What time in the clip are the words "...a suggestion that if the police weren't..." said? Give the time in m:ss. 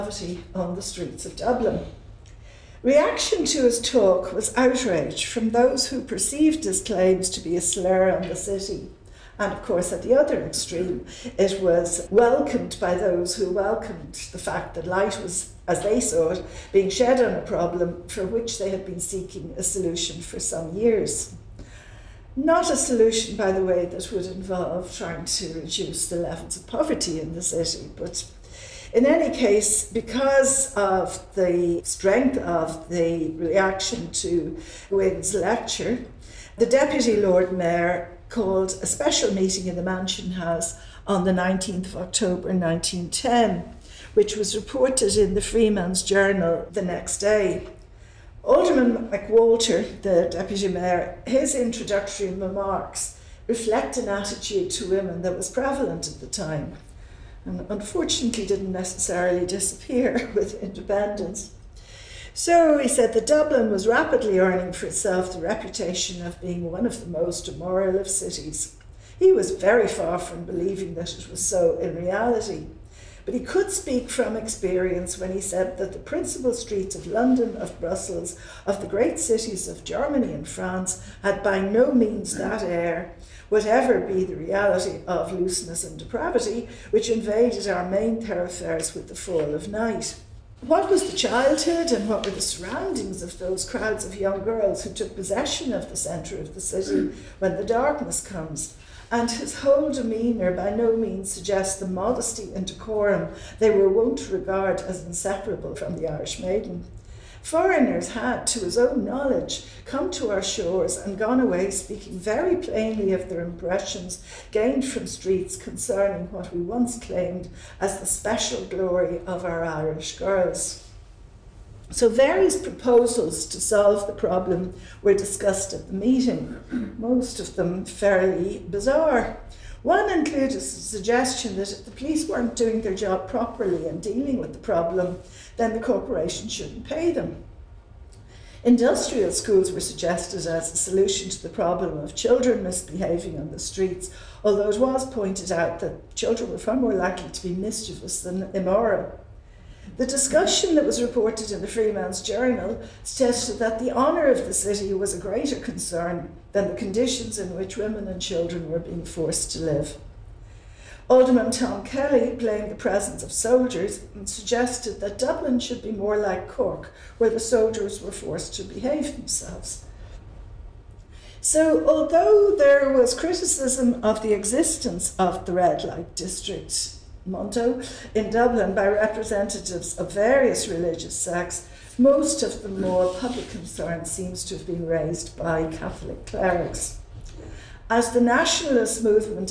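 2:10.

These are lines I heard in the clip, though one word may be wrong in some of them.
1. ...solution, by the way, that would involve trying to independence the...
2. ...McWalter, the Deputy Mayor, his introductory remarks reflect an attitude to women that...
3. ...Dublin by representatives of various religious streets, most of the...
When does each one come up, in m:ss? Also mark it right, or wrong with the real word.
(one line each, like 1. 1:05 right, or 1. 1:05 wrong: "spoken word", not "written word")
1. 0:22 wrong: "reduce", not "independence"
2. 0:49 right
3. 2:58 wrong: "sects", not "streets".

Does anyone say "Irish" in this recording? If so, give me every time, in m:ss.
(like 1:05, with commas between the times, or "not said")
1:46, 1:59.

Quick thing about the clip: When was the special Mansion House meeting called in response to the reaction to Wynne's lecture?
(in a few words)
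19 October 1910.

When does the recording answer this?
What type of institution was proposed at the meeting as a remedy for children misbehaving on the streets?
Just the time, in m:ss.
2:18.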